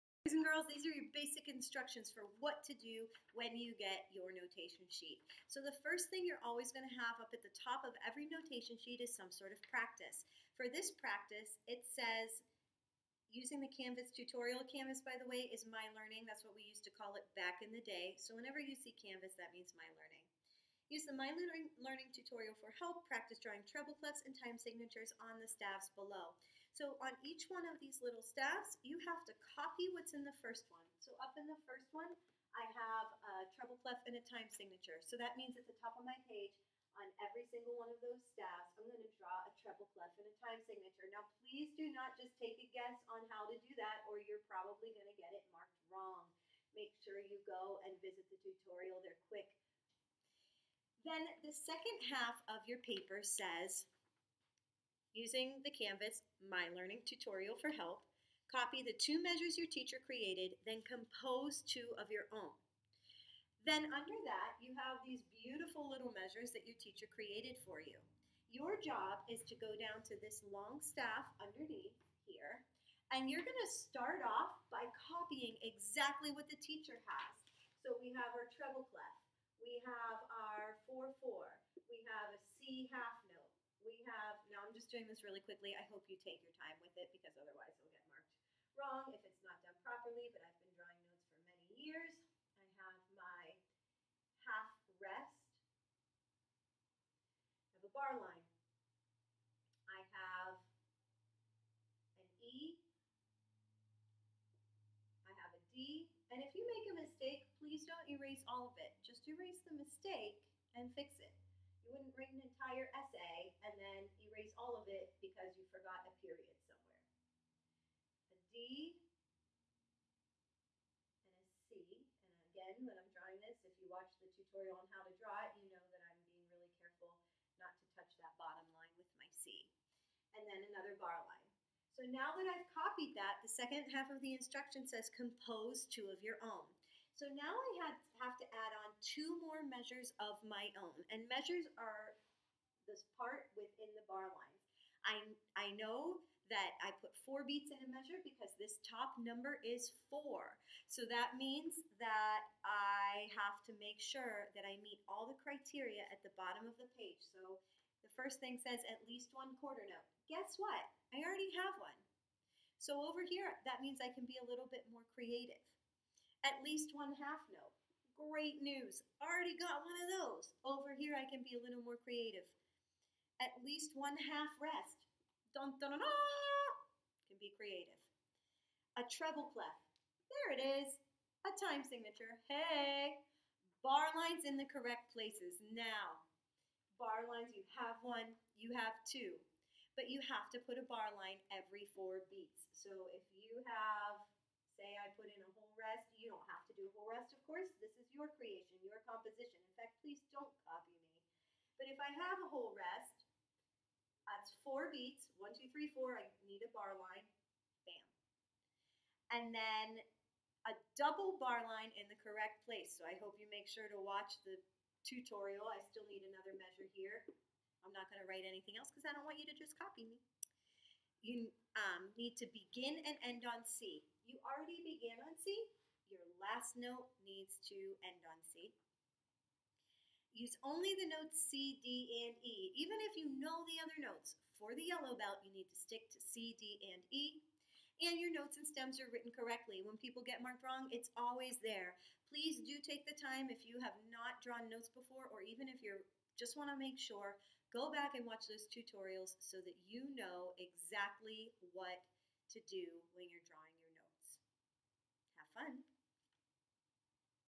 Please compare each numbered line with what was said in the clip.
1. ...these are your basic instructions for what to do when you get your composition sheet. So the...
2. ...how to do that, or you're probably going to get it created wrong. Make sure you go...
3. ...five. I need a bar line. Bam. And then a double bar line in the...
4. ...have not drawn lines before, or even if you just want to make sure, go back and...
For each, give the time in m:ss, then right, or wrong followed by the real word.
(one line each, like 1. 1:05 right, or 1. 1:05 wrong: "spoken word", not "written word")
1. 0:00 wrong: "notation", not "composition"
2. 0:43 wrong: "marked", not "created"
3. 3:25 wrong: "four", not "five"
4. 4:03 wrong: "notes", not "lines".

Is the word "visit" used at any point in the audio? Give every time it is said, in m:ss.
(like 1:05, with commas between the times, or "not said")
0:48.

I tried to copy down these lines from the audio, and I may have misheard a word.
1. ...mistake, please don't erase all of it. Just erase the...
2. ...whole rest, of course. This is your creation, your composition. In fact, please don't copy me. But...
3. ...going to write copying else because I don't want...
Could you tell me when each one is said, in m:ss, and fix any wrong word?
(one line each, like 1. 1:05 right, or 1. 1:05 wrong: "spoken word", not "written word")
1. 1:47 right
2. 3:16 right
3. 3:38 wrong: "anything", not "copying".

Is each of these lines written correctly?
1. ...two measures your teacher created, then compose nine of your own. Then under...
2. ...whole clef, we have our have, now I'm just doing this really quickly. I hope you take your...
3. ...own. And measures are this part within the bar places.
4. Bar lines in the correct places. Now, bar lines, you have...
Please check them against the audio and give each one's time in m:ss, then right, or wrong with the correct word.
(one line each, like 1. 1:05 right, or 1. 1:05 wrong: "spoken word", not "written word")
1. 0:58 wrong: "two", not "nine"
2. 1:18 wrong: "treble", not "whole"
3. 2:20 wrong: "lines", not "places"
4. 3:03 right.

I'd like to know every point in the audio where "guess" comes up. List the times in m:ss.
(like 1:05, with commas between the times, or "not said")
0:42, 2:40.